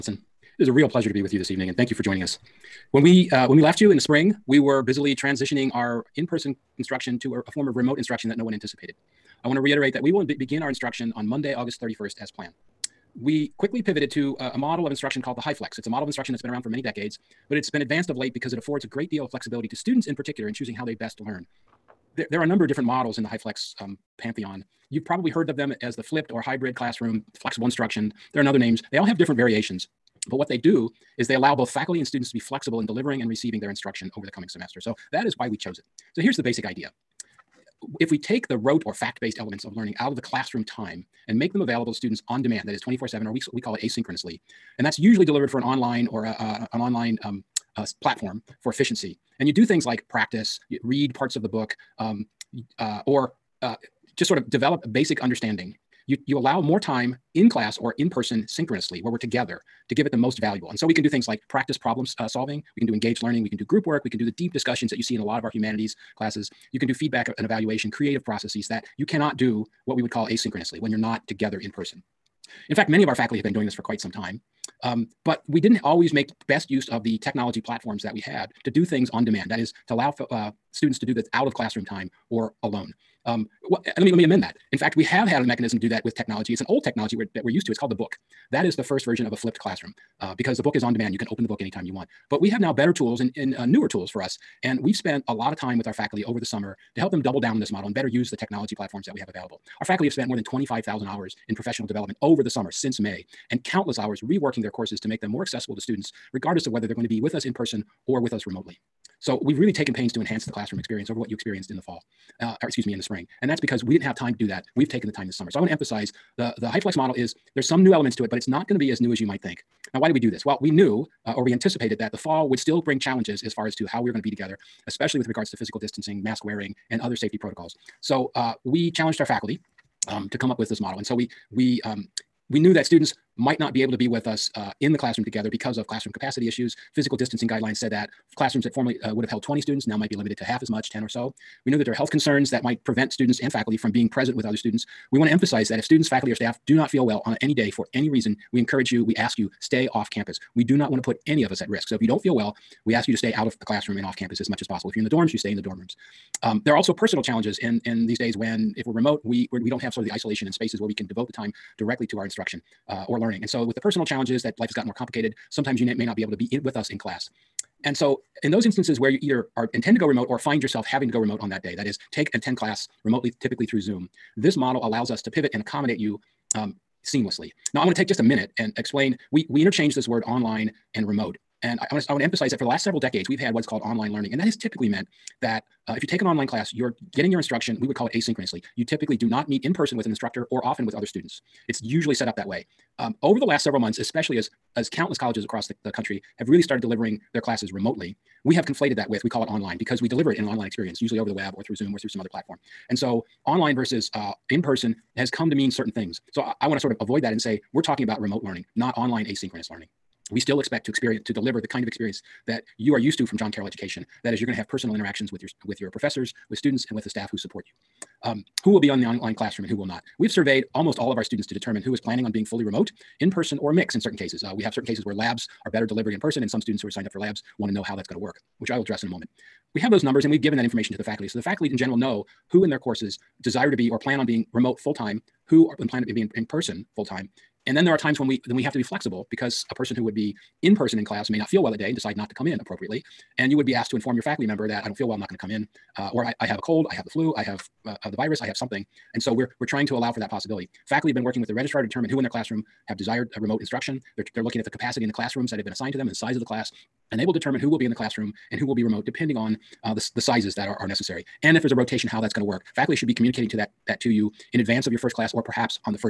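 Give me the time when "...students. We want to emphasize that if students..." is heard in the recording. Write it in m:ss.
2:24.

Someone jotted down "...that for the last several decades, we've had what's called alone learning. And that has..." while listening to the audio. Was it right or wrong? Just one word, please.
wrong.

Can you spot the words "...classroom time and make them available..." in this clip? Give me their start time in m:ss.
0:40.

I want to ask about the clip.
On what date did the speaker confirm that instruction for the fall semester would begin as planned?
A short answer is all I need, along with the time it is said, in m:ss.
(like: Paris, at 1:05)
Monday, August 31st, at 0:11.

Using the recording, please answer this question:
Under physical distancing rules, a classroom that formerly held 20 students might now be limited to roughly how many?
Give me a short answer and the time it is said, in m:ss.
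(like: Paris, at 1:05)
10, at 2:20.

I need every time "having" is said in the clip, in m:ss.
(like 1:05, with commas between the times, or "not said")
2:50.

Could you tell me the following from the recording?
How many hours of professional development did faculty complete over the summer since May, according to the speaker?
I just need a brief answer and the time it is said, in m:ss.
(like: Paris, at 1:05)
More than 25,000, at 1:40.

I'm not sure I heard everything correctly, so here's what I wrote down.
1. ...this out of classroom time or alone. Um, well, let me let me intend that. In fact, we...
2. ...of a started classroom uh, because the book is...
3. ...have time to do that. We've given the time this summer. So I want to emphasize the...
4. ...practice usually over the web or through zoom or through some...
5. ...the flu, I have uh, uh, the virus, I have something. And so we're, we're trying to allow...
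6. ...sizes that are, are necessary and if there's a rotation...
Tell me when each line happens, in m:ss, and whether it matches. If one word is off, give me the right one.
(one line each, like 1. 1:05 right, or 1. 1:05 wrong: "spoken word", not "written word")
1. 1:21 wrong: "amend", not "intend"
2. 1:29 wrong: "flipped", not "started"
3. 1:54 wrong: "taken", not "given"
4. 3:20 wrong: "experience", not "practice"
5. 4:07 right
6. 4:20 right.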